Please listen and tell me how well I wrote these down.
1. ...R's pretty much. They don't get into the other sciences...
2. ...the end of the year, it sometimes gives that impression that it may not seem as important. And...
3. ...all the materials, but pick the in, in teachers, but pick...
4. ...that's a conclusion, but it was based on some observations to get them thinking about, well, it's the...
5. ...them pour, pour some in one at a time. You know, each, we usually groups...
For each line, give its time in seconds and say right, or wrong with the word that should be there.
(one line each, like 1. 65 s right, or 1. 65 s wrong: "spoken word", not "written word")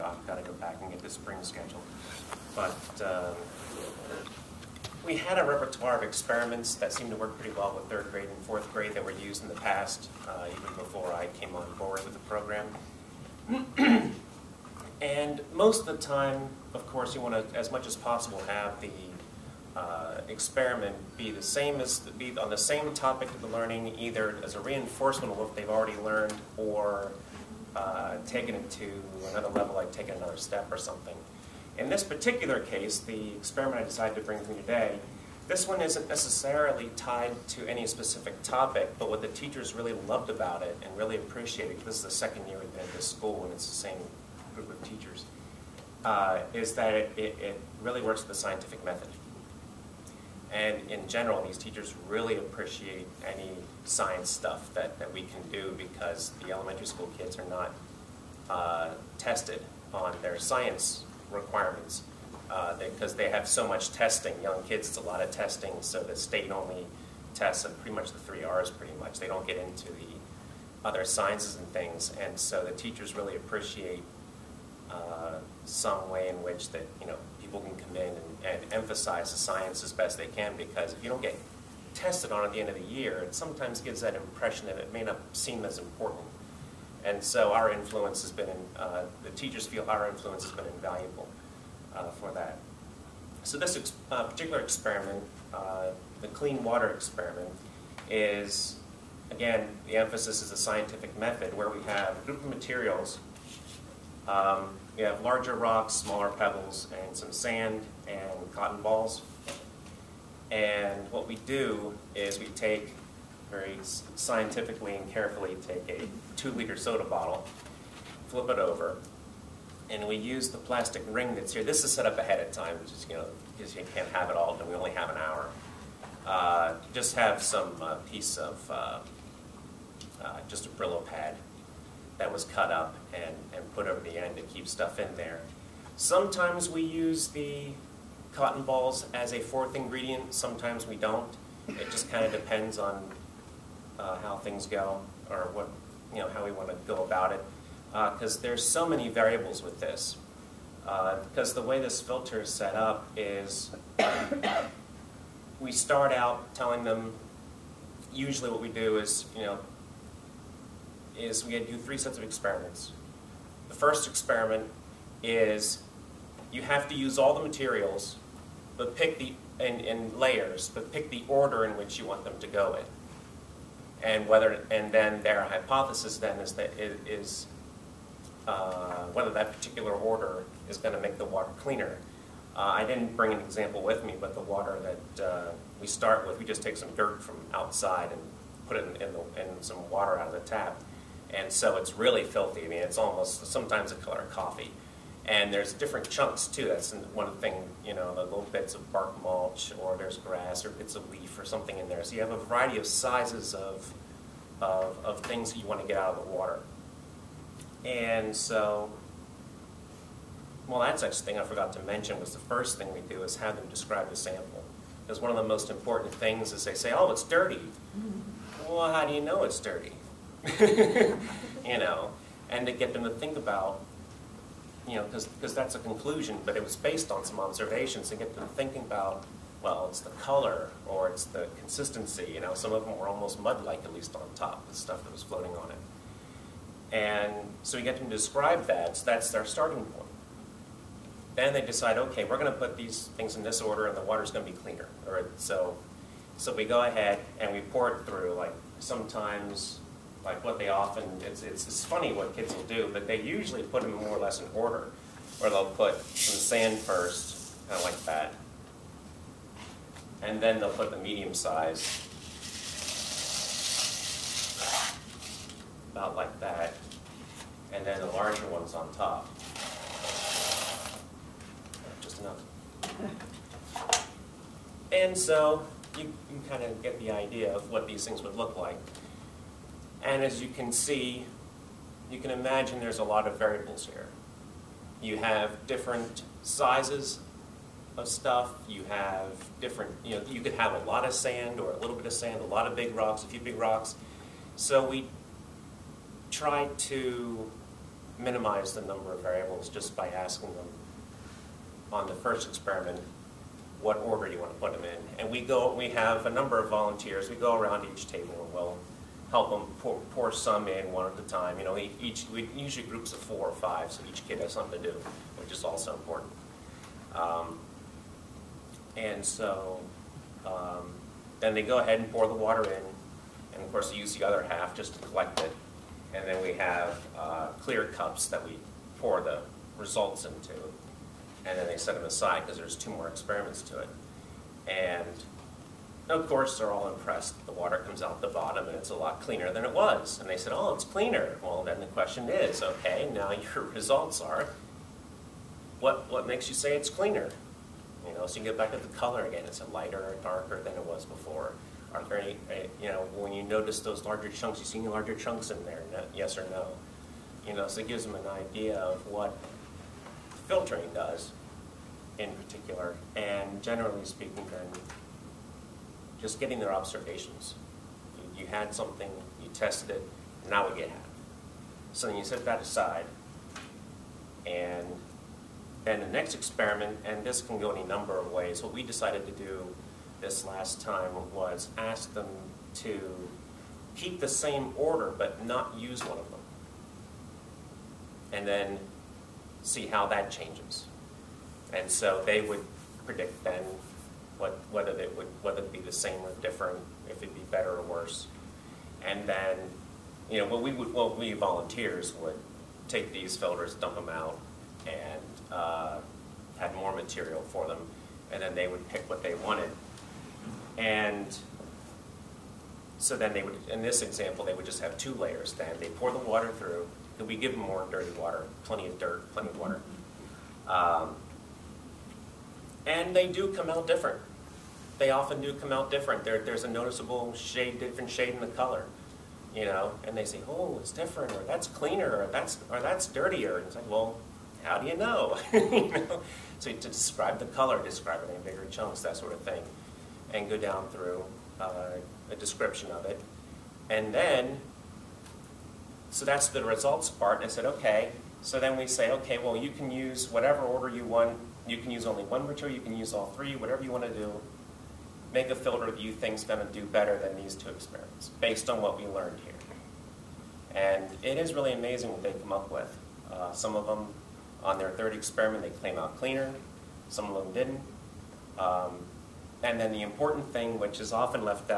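1. 68 s right
2. 82 s right
3. 167 s wrong: "layers", not "teachers"
4. 225 s right
5. 309 s right.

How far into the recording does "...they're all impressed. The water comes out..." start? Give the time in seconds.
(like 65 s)
336 s.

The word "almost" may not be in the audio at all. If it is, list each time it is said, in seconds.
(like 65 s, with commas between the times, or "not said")
192 s, 233 s.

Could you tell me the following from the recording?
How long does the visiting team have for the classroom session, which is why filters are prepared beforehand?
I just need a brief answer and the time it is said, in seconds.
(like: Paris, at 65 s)
an hour, at 125 s.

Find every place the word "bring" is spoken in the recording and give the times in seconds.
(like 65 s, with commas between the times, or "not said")
34 s, 183 s.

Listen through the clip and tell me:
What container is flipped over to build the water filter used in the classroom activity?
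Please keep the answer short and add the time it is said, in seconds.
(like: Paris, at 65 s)
two liter soda bottle, at 116 s.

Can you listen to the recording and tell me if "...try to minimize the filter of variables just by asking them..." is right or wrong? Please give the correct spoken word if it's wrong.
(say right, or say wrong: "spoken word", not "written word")
wrong: "number", not "filter".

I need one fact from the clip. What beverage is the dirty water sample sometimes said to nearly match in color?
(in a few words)
coffee.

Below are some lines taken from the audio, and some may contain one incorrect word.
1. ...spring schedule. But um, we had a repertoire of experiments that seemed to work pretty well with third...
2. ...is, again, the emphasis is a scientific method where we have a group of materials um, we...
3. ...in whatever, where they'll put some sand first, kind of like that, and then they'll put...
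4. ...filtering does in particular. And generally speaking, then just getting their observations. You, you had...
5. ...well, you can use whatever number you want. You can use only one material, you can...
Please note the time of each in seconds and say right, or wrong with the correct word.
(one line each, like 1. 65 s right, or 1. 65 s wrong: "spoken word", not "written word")
1. 1 s right
2. 98 s right
3. 254 s wrong: "order", not "whatever"
4. 360 s right
5. 449 s wrong: "order", not "number".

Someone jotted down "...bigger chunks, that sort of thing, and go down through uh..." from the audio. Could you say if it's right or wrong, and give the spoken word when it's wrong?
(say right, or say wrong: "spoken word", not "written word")
right.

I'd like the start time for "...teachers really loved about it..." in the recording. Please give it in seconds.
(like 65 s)
39 s.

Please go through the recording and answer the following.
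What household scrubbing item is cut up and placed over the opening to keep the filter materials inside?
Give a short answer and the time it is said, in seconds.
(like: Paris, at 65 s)
Brillo pad, at 130 s.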